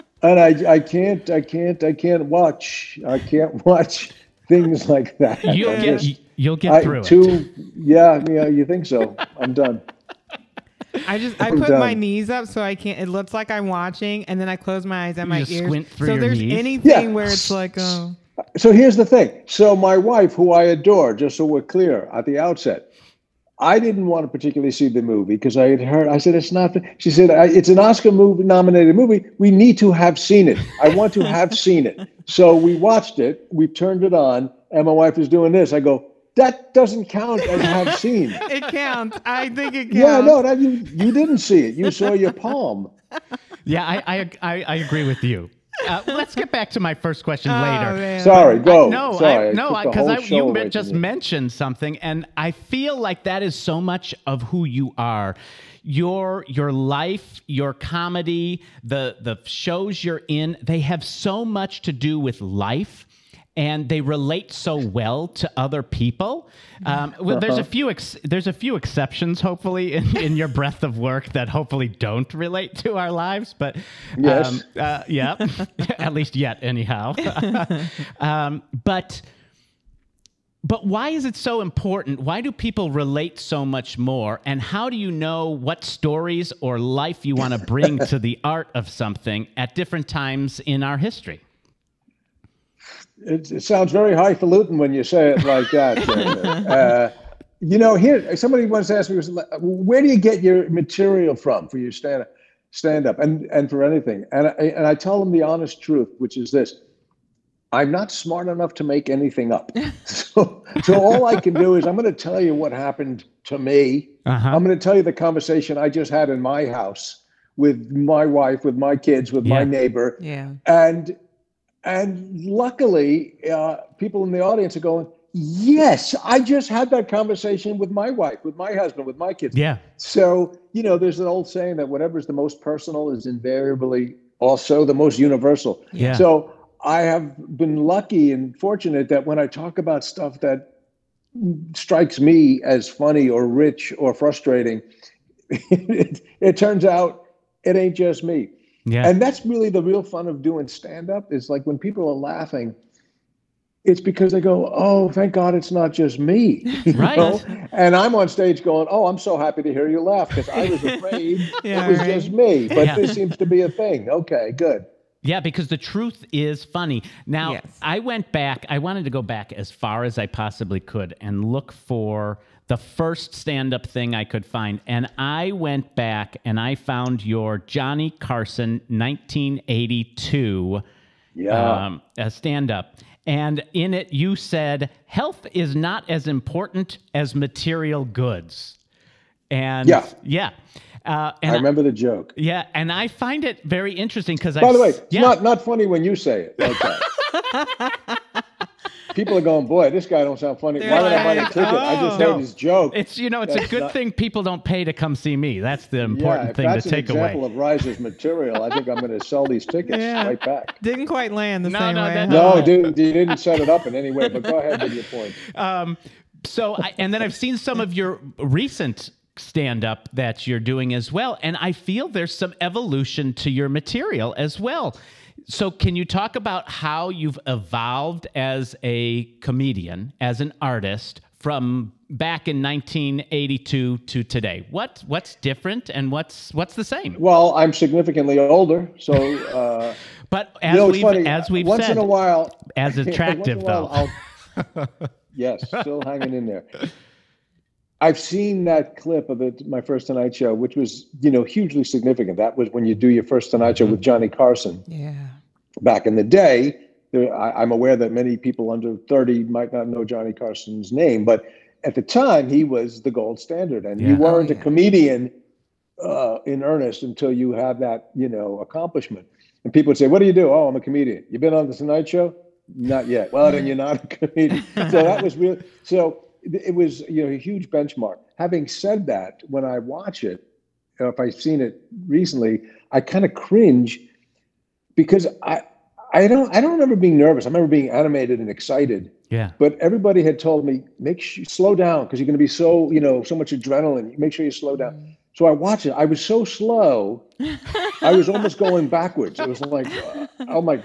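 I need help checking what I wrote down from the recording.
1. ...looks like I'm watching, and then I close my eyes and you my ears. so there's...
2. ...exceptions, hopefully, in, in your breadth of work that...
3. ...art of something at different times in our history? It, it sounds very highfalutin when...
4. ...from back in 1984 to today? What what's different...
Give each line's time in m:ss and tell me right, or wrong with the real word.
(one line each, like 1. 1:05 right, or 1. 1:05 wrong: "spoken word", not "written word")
1. 0:13 right
2. 1:08 right
3. 1:28 right
4. 3:51 wrong: "1982", not "1984".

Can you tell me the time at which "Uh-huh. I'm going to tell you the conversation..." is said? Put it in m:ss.
1:54.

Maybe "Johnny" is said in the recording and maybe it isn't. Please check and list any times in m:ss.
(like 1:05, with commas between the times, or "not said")
2:57, 4:14, 4:20.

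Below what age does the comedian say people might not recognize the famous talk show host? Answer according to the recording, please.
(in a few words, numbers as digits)
30.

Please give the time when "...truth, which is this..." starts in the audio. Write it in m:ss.
1:45.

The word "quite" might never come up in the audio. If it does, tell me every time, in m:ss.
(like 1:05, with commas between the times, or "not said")
3:31.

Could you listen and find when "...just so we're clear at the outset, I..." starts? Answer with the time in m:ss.
0:21.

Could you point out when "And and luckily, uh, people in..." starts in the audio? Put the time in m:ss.
2:00.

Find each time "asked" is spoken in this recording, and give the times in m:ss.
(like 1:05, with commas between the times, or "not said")
1:38.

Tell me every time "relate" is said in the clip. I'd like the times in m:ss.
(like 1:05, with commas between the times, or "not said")
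1:04, 1:12, 1:22.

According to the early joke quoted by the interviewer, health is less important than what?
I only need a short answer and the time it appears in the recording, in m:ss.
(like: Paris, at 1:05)
material goods, at 3:07.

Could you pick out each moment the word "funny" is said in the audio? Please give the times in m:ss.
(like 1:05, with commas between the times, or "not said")
2:22, 2:46, 3:15, 3:20, 4:01.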